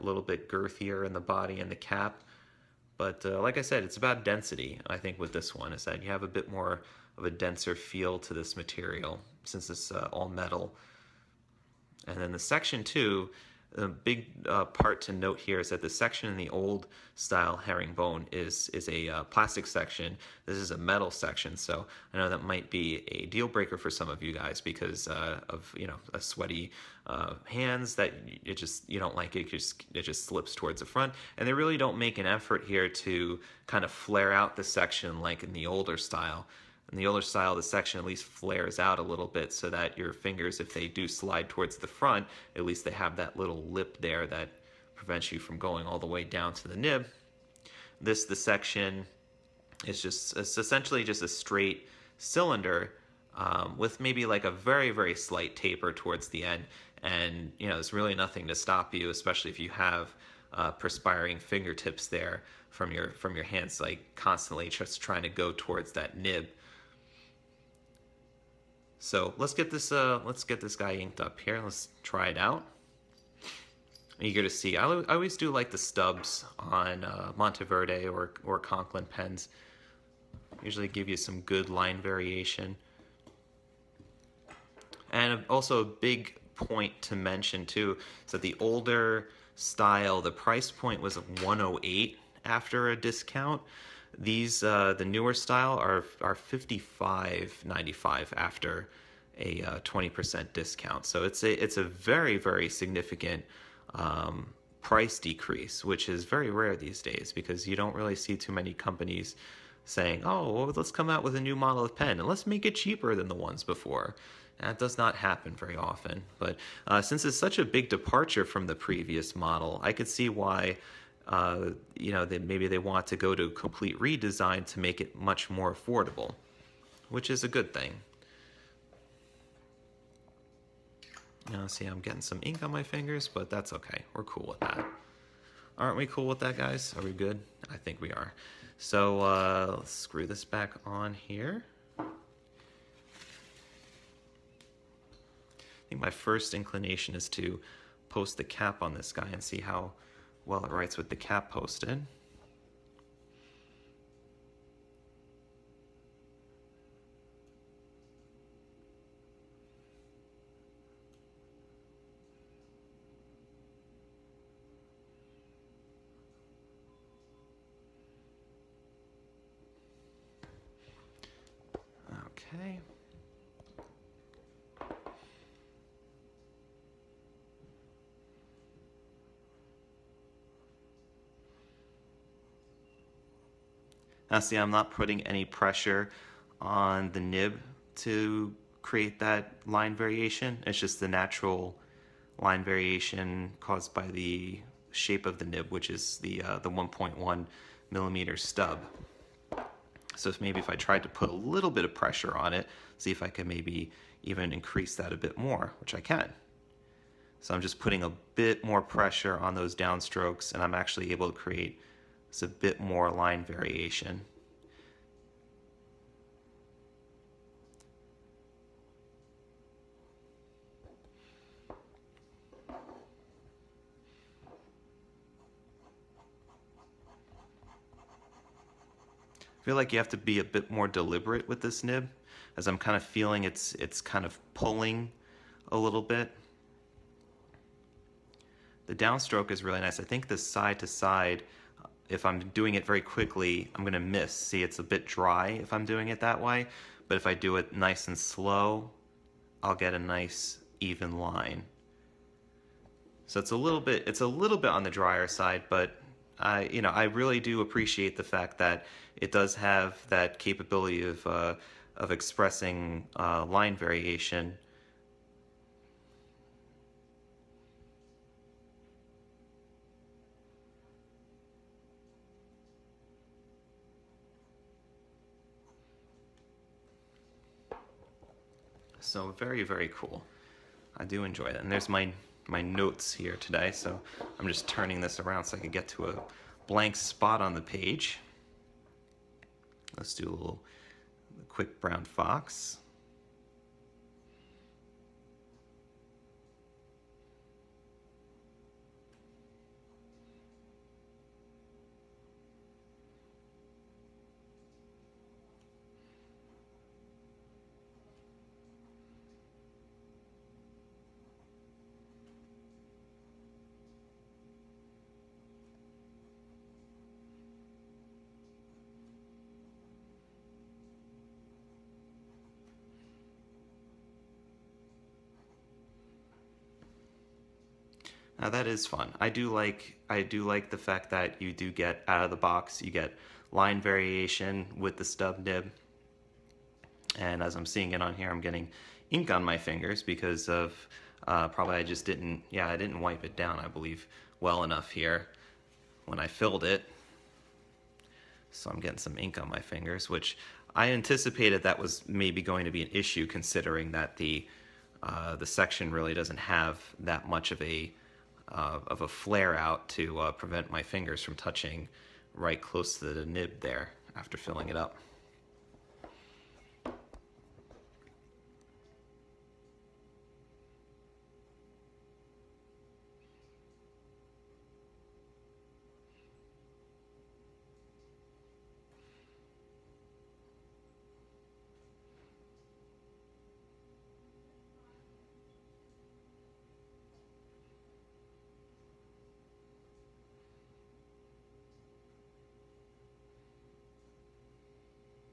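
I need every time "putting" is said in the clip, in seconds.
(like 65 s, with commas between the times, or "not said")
184 s, 207 s.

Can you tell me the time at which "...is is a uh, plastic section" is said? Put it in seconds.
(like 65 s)
18 s.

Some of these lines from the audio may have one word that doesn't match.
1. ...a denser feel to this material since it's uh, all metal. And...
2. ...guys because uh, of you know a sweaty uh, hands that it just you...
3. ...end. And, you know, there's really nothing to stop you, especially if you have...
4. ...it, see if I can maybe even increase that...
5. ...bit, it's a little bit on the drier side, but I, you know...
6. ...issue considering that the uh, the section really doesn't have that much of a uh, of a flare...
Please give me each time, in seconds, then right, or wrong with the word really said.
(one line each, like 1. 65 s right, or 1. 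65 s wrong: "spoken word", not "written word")
1. 7 s right
2. 24 s right
3. 56 s right
4. 202 s right
5. 253 s right
6. 352 s right.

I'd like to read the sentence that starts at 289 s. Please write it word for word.
Let's do a little quick brown fox.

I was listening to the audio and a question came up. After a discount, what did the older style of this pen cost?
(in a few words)
$108.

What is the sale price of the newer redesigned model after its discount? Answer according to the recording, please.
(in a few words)
$55.95.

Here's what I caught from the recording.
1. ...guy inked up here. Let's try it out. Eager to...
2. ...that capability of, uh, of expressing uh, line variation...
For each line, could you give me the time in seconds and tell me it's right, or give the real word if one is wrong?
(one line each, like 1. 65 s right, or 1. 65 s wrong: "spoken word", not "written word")
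1. 70 s right
2. 260 s right.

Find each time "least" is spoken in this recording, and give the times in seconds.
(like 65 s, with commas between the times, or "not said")
38 s, 42 s.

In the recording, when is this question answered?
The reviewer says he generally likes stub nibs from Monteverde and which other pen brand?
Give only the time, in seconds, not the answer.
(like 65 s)
78 s.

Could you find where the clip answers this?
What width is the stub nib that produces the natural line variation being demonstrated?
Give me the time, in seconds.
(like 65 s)
196 s.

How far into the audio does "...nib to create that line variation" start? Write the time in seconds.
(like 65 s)
187 s.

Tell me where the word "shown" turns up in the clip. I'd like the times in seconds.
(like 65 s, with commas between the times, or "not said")
not said.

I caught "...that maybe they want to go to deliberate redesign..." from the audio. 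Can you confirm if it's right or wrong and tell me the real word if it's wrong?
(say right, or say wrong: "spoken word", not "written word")
wrong: "complete", not "deliberate".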